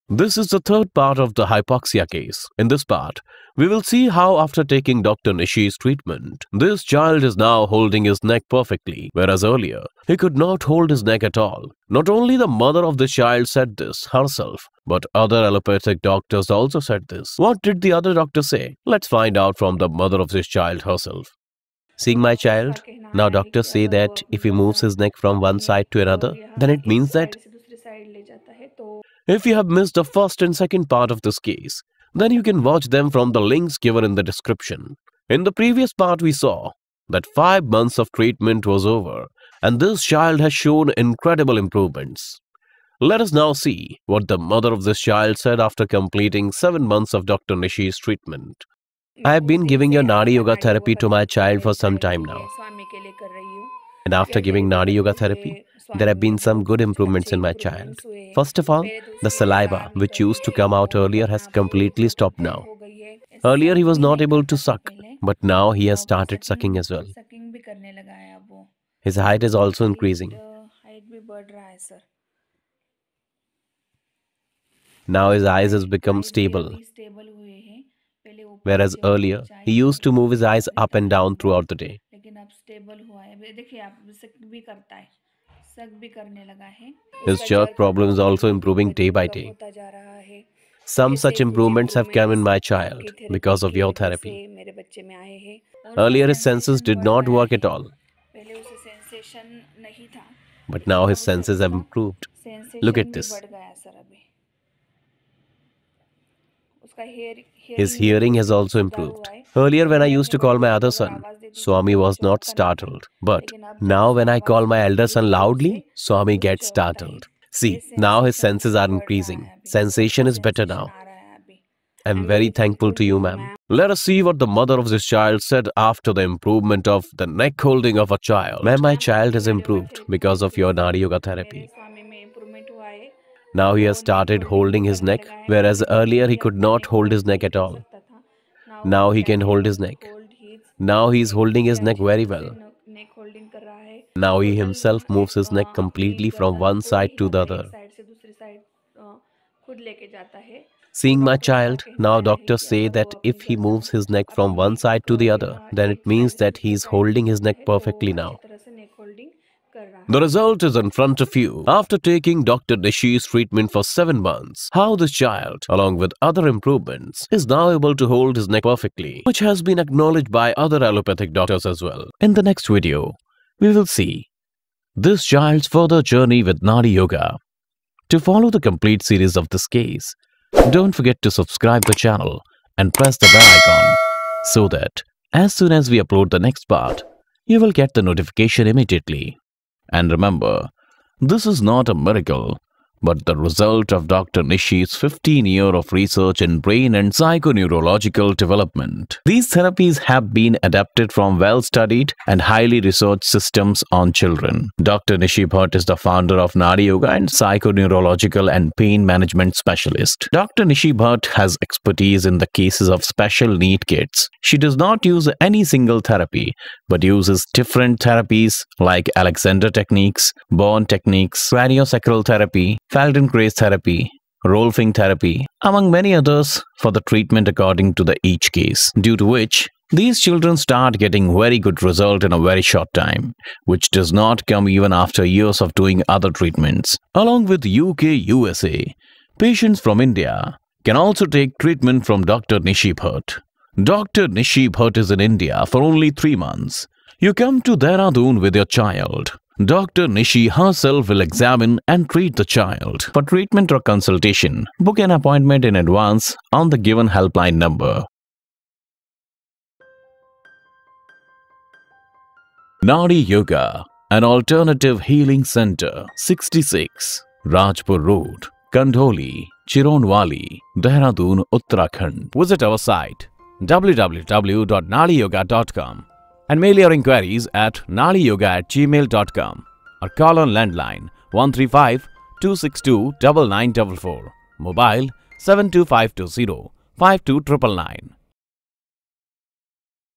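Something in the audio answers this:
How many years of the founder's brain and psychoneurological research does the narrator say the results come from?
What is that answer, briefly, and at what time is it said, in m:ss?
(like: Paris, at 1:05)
15, at 3:14.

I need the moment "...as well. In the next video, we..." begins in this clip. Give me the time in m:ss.
2:51.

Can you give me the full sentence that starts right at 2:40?
The result is in front of you.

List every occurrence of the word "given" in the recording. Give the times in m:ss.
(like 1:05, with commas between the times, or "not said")
0:33, 4:16.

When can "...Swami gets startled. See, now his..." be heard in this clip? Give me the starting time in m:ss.
1:55.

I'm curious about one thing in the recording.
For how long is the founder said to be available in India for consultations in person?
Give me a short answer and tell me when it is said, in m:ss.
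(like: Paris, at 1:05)
3 months, at 4:06.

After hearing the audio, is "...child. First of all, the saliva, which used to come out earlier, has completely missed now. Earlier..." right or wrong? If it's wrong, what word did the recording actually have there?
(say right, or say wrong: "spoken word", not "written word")
wrong: "stopped", not "missed".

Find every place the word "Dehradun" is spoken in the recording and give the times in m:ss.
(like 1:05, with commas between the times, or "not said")
4:07, 4:30.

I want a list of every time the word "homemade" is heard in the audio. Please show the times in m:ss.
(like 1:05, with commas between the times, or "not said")
not said.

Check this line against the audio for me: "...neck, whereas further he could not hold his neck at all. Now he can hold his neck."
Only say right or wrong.
wrong.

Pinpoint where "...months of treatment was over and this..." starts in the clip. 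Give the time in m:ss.
0:37.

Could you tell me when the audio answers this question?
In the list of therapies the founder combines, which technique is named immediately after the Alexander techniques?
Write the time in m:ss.
3:40.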